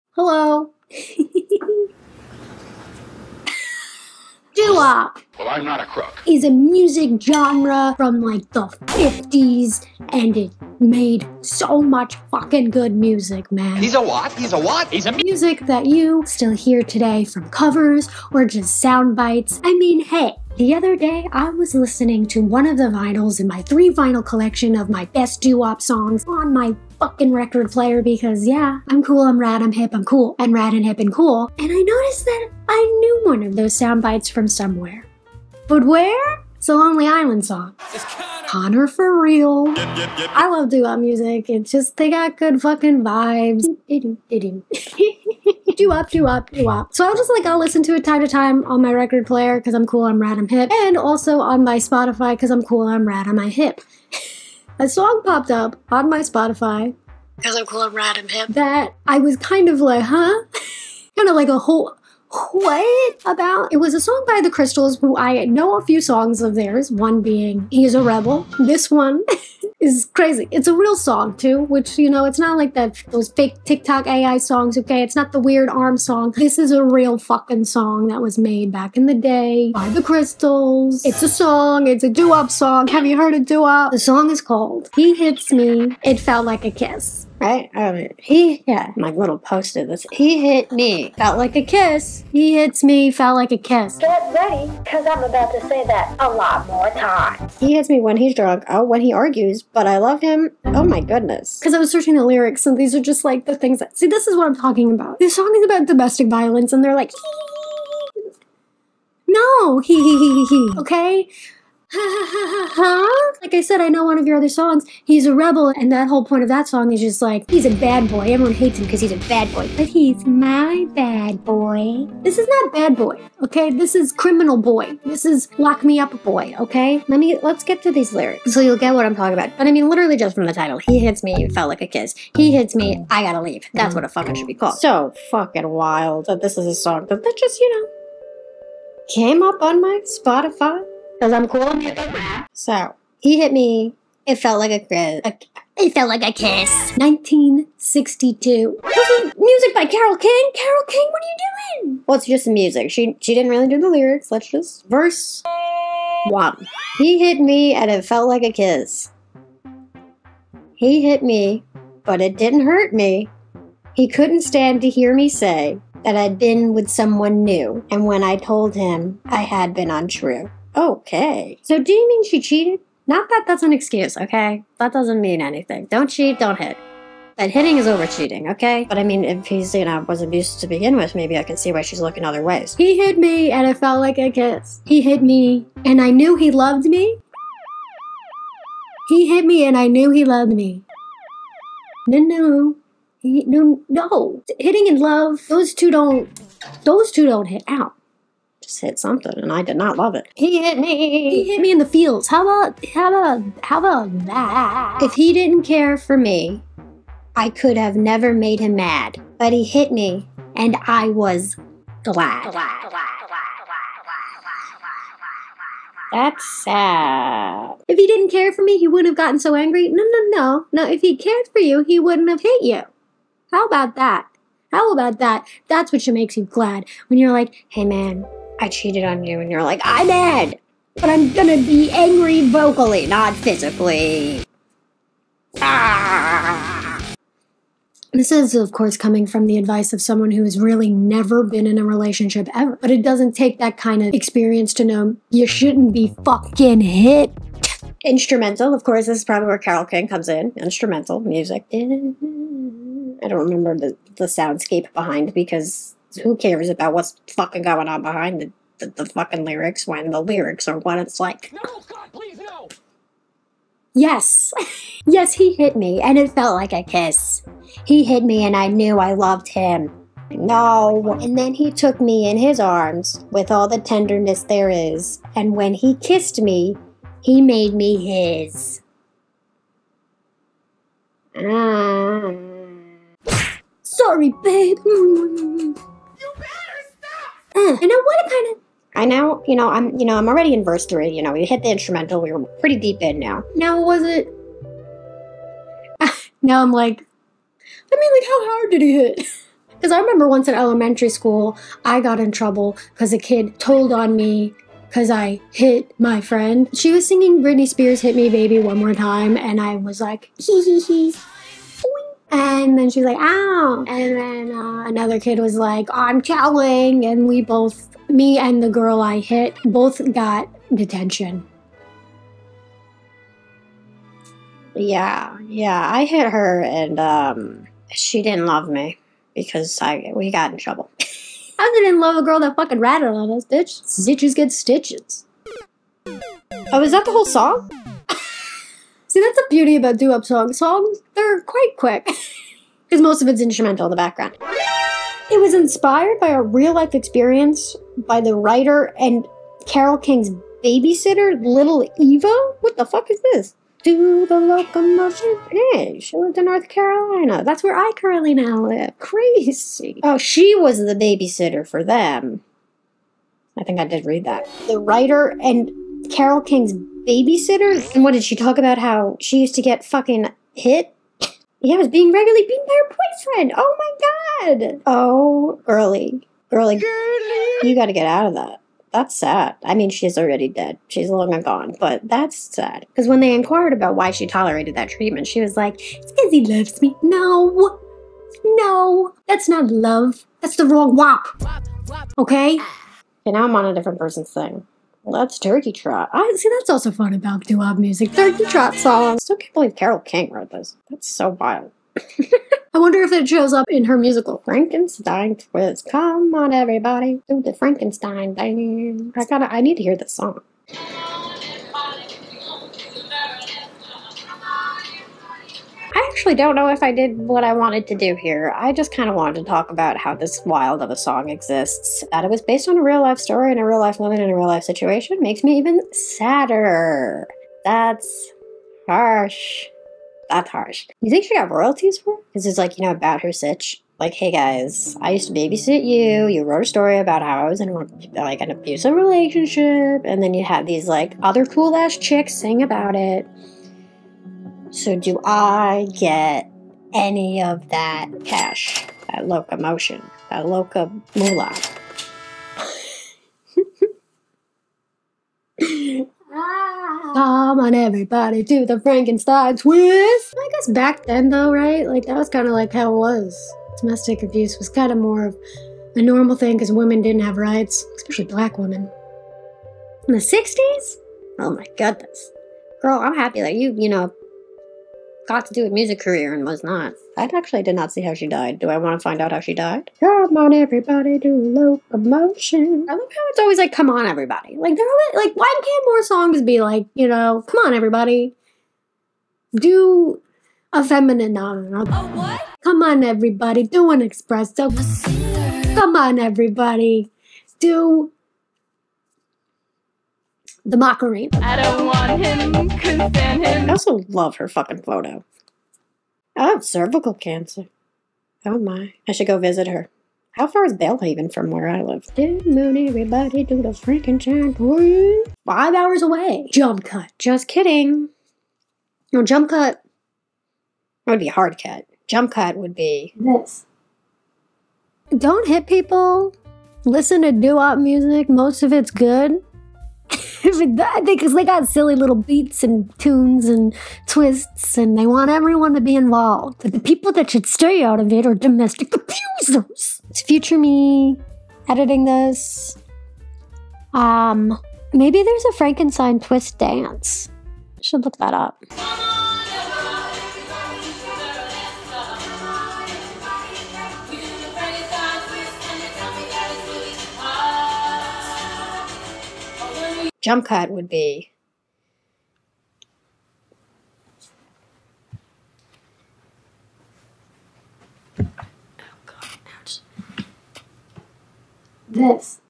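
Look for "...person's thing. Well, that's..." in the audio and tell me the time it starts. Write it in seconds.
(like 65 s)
393 s.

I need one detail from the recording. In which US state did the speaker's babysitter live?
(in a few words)
North Carolina.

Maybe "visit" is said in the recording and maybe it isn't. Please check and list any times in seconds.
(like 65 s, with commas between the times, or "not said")
509 s.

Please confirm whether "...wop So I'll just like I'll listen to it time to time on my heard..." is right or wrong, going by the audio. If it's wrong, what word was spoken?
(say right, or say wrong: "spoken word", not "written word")
wrong: "record", not "heard".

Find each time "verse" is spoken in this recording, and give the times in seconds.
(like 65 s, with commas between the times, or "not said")
154 s, 290 s.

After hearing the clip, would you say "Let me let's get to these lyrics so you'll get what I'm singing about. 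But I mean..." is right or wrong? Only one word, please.
wrong.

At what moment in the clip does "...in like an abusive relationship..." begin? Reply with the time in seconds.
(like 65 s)
437 s.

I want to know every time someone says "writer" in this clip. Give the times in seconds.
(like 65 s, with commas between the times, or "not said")
348 s, 364 s.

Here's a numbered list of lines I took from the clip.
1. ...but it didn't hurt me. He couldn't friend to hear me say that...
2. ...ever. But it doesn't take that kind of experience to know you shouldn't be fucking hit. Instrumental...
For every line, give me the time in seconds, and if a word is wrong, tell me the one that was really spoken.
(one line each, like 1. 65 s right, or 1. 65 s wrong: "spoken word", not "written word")
1. 162 s wrong: "stand", not "friend"
2. 242 s right.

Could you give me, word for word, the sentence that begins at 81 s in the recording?
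It's a song, it's a doo-wop song.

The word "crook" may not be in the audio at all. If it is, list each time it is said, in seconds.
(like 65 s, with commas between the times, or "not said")
5 s.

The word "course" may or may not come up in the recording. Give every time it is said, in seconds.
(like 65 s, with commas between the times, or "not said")
238 s, 248 s.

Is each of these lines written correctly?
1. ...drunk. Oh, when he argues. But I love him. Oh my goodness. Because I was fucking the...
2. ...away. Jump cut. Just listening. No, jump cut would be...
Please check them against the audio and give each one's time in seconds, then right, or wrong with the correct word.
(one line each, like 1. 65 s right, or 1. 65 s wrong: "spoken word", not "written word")
1. 98 s wrong: "searching", not "fucking"
2. 516 s wrong: "kidding", not "listening".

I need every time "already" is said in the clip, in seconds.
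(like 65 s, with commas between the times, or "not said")
290 s, 380 s.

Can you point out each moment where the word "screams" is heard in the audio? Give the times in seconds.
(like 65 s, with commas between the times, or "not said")
not said.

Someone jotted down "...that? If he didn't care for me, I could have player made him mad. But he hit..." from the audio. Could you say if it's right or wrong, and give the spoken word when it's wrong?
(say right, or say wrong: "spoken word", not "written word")
wrong: "never", not "player".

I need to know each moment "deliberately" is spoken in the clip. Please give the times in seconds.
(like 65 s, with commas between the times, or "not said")
not said.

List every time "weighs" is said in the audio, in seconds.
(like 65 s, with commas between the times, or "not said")
not said.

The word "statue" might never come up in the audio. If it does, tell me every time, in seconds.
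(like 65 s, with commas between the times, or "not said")
not said.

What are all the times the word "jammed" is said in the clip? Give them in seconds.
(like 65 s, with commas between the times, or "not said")
not said.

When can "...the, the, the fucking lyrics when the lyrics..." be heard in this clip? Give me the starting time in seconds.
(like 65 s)
258 s.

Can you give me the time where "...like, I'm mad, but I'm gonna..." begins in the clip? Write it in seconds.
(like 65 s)
229 s.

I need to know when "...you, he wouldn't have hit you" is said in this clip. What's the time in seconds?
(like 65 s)
221 s.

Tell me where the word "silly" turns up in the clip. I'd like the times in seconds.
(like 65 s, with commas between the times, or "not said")
531 s.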